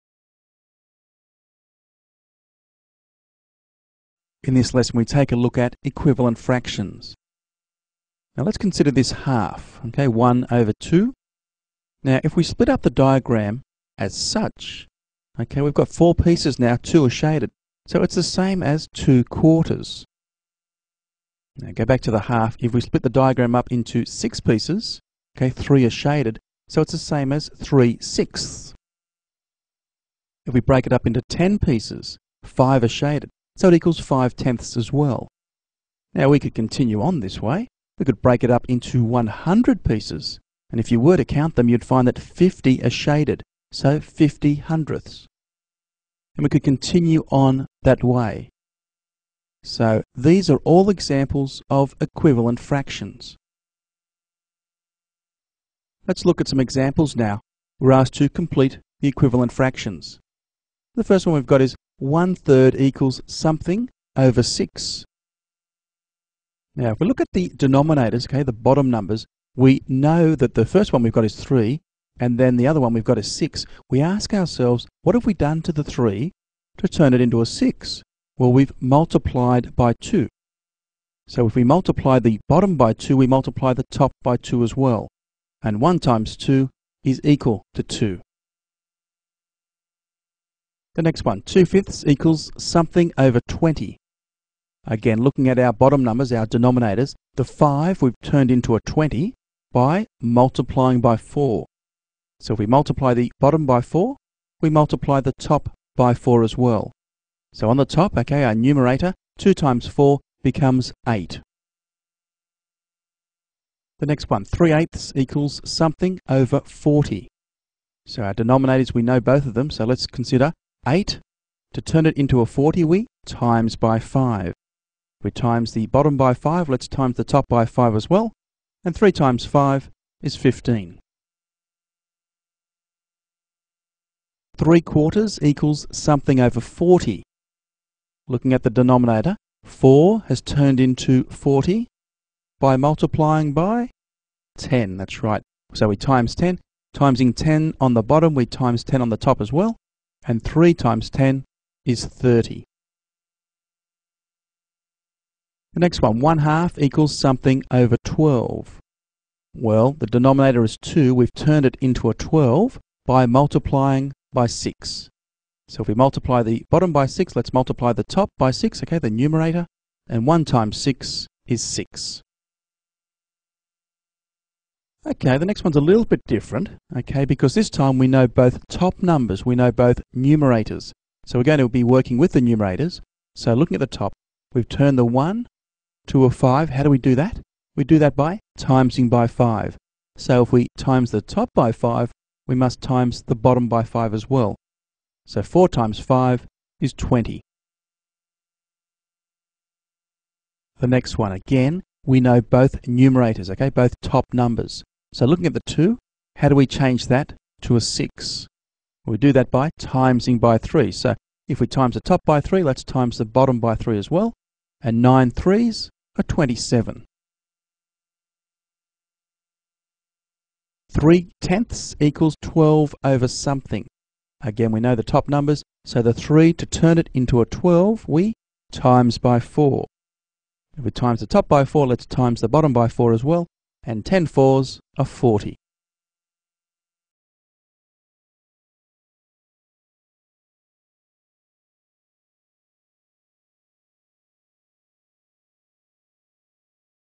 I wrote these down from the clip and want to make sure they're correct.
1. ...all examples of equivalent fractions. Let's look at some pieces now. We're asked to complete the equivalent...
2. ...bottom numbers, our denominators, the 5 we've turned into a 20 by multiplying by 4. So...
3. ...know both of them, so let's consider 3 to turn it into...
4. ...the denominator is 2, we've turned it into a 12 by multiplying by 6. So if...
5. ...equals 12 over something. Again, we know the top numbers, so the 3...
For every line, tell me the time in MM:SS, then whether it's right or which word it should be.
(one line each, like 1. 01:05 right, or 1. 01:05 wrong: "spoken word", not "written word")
1. 00:50 wrong: "examples", not "pieces"
2. 01:35 right
3. 01:59 wrong: "8", not "3"
4. 02:39 right
5. 03:41 right.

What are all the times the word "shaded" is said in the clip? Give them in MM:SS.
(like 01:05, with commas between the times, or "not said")
00:17, 00:25, 00:32, 00:42.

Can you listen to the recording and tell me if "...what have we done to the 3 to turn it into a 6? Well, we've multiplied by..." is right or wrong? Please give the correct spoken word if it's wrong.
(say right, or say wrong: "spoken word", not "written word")
right.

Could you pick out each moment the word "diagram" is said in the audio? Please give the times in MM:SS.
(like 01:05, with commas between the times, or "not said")
00:12, 00:23.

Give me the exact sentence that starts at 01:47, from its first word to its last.
So on the top, okay, our numerator, 2 times 4 becomes 8.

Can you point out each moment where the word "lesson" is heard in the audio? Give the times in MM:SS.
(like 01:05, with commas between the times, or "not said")
00:04.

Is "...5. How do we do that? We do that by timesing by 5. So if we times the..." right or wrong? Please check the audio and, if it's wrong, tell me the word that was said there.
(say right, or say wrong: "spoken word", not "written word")
right.